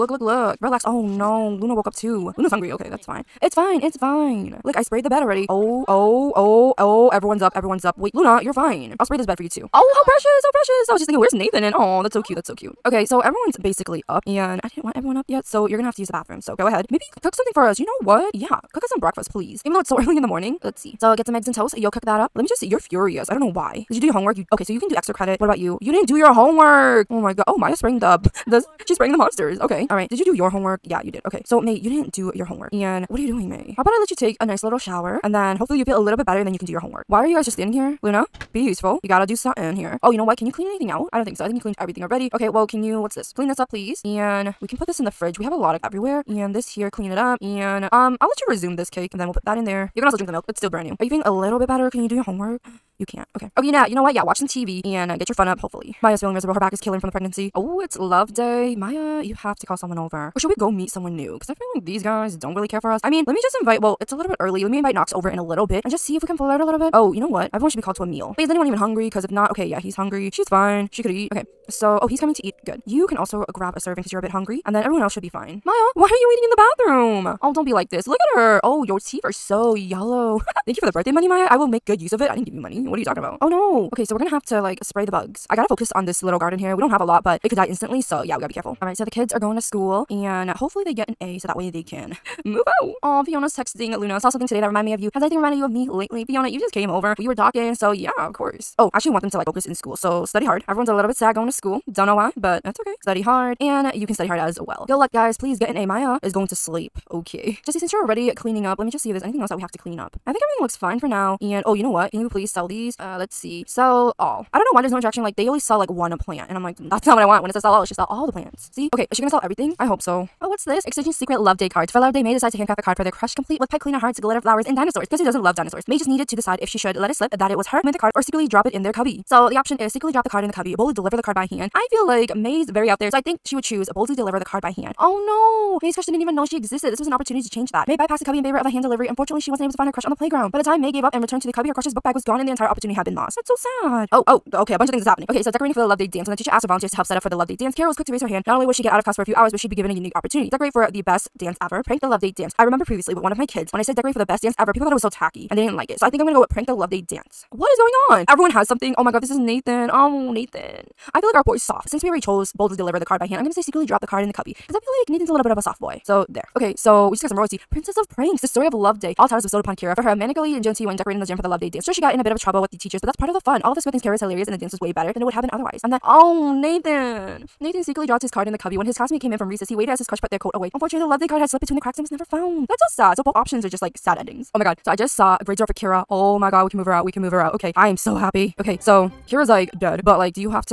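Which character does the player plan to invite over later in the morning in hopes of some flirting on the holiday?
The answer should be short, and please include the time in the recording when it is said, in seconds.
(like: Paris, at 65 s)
Knox, at 64 s.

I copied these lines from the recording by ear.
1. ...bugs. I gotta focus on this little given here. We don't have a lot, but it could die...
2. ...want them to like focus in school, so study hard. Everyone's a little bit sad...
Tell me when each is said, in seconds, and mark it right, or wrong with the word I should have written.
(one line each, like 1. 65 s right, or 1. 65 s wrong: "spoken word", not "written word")
1. 85 s wrong: "garden", not "given"
2. 99 s right.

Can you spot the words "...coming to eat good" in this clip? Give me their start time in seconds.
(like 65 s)
72 s.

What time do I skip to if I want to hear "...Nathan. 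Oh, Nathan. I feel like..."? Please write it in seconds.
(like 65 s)
159 s.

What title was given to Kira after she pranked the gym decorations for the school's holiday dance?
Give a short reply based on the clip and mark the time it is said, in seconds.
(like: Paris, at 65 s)
Princess of Pranks, at 167 s.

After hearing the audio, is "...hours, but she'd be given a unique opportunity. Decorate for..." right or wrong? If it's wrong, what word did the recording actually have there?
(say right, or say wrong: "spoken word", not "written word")
right.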